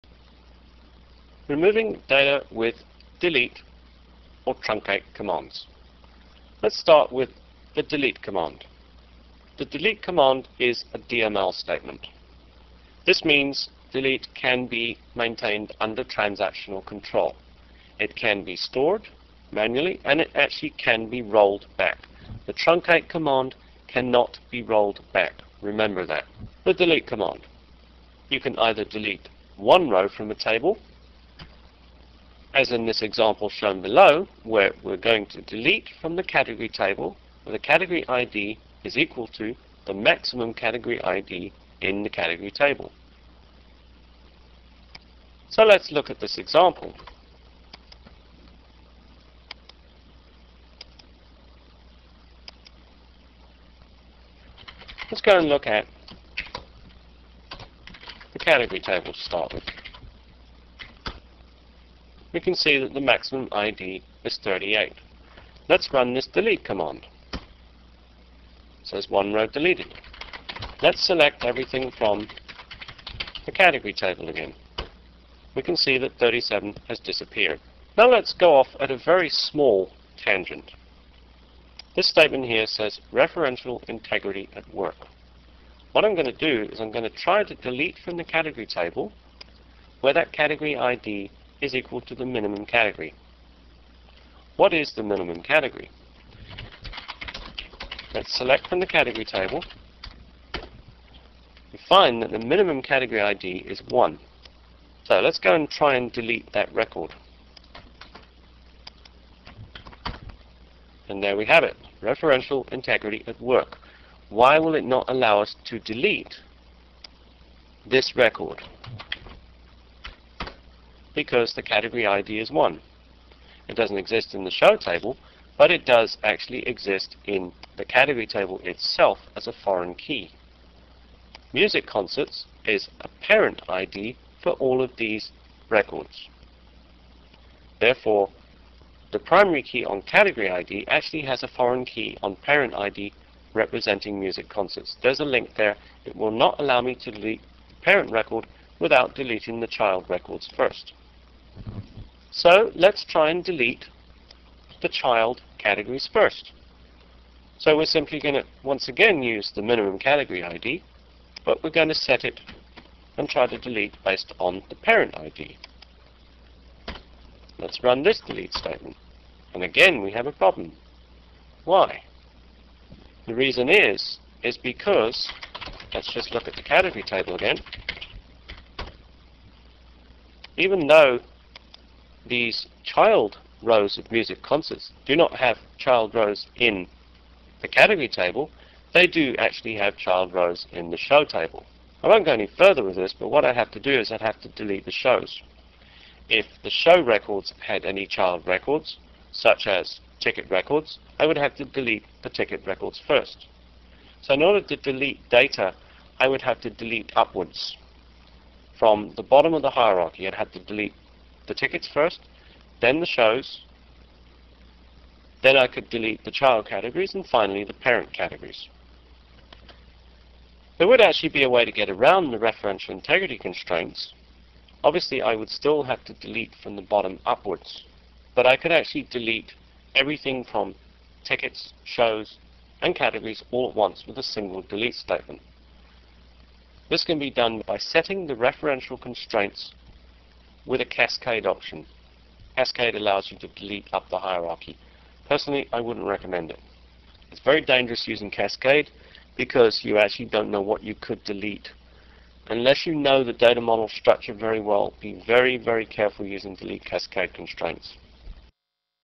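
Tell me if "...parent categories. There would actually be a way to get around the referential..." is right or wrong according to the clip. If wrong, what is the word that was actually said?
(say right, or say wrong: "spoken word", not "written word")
right.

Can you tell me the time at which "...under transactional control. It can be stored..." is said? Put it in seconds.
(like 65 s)
15 s.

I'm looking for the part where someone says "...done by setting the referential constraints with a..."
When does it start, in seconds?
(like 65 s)
237 s.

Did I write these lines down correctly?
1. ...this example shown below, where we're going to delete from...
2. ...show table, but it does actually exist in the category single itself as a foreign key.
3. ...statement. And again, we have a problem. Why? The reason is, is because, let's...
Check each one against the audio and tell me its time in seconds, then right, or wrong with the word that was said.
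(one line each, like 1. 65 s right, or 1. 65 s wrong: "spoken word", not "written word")
1. 32 s right
2. 124 s wrong: "table", not "single"
3. 168 s right.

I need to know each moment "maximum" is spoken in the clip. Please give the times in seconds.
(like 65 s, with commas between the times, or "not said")
39 s, 63 s.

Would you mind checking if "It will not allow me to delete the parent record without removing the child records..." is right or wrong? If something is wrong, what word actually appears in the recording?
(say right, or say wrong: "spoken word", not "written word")
wrong: "deleting", not "removing".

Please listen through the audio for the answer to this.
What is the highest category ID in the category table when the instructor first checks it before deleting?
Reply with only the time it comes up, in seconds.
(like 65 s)
64 s.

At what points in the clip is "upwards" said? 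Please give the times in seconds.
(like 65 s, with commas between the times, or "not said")
207 s, 227 s.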